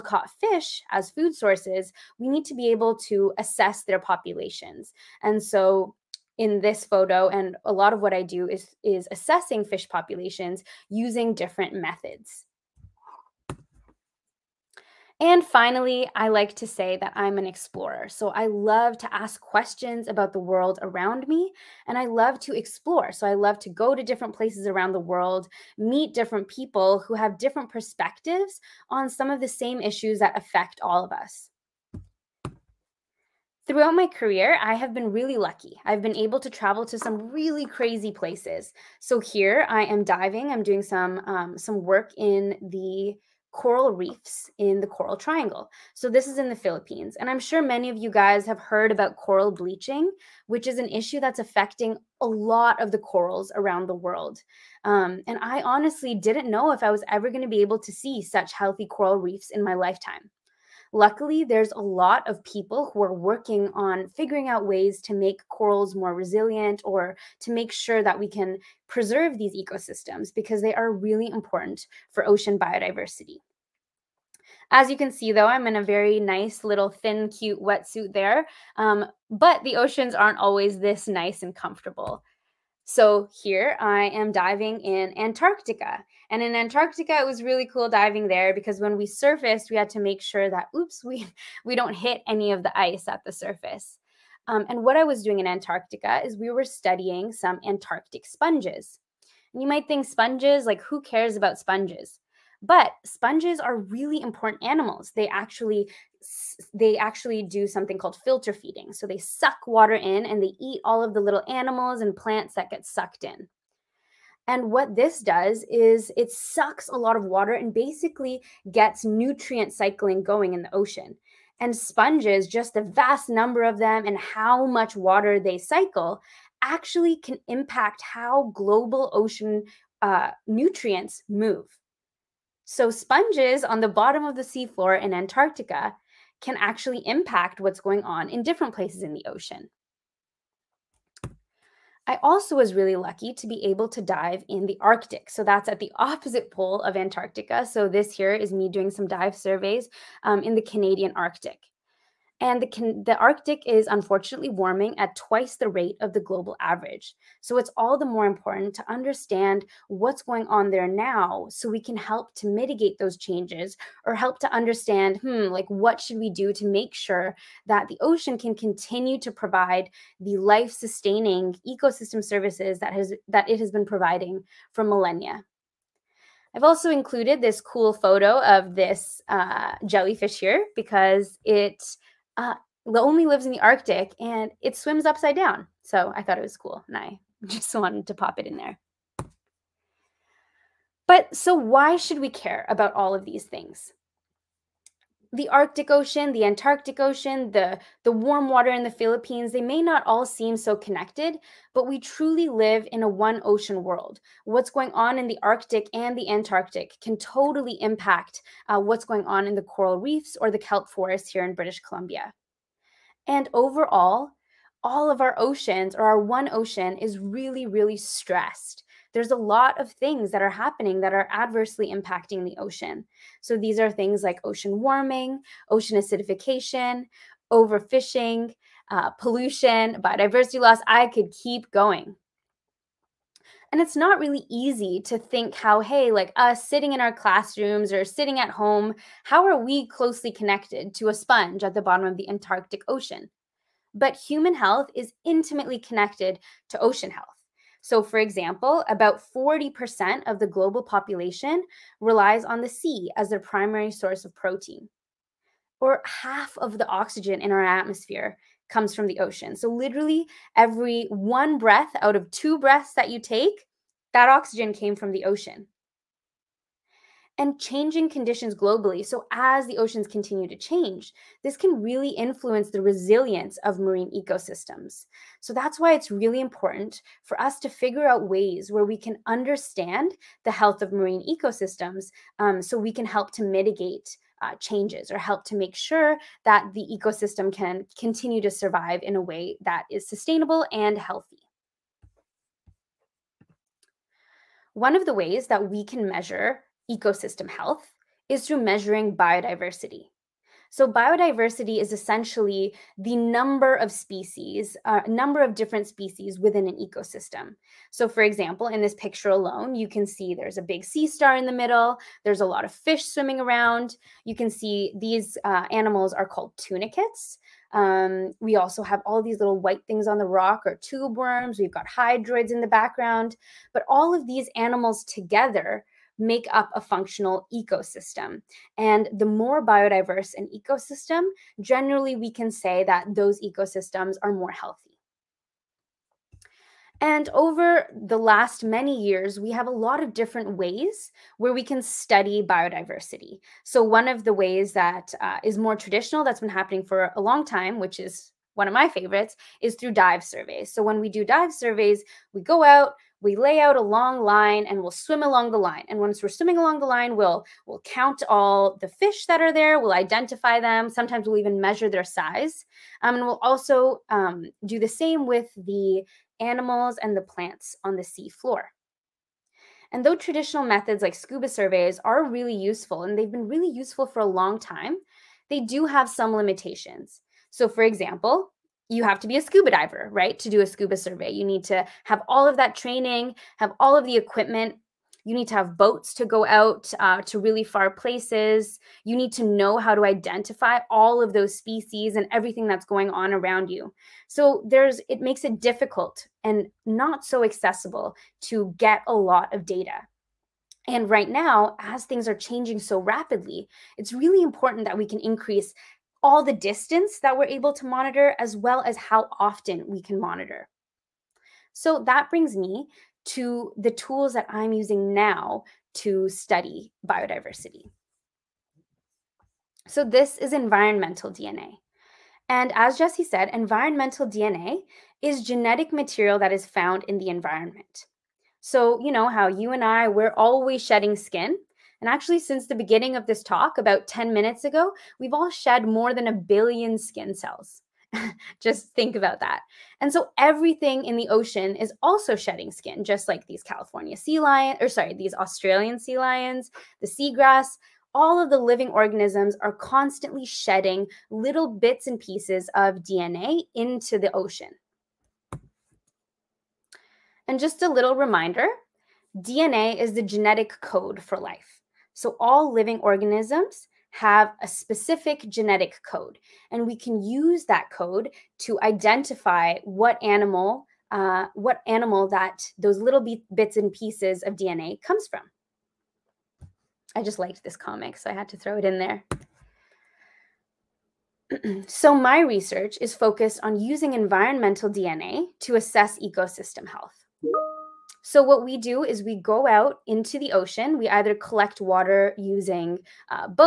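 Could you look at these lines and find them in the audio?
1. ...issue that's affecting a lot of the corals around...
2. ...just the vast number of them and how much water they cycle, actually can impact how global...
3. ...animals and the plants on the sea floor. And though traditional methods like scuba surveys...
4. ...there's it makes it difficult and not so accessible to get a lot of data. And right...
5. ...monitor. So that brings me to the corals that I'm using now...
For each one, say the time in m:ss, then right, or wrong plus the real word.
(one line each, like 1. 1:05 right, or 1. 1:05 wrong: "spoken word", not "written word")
1. 0:50 right
2. 2:02 right
3. 6:06 right
4. 6:34 right
5. 6:50 wrong: "tools", not "corals".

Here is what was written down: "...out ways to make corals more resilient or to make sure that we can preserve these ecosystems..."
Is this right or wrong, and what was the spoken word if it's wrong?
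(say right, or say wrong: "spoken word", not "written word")
right.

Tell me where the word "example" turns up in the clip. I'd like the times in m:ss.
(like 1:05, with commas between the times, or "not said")
4:08, 5:08, 6:17.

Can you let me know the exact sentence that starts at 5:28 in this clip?
And the more biodiverse an ecosystem, generally we can say that those ecosystems are more healthy.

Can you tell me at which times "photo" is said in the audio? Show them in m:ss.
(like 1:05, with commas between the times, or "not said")
0:06, 2:57.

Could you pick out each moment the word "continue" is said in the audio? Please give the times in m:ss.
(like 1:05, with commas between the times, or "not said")
2:48, 4:30, 4:47.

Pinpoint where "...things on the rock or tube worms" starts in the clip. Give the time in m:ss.
5:19.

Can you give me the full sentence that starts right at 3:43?
So these are things like ocean warming, ocean acidification, overfishing, uh, pollution, biodiversity loss.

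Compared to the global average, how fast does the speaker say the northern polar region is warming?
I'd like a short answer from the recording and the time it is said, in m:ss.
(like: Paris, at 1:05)
twice the rate, at 2:35.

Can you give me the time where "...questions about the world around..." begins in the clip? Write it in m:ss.
0:19.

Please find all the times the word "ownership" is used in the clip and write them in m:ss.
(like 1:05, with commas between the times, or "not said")
not said.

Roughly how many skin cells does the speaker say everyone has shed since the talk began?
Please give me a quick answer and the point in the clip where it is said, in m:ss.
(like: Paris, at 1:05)
more than a billion, at 7:15.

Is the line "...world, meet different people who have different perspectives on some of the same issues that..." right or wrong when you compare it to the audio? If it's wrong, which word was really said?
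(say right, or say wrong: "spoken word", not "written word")
right.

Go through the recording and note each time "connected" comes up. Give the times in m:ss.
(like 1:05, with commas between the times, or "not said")
3:20, 4:00, 4:05.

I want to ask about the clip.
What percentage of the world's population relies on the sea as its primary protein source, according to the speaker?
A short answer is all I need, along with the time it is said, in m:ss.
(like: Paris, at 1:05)
40%, at 4:09.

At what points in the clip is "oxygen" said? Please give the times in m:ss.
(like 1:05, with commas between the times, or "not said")
4:16, 4:24.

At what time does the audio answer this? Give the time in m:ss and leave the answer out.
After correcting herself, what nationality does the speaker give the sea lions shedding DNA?
7:25.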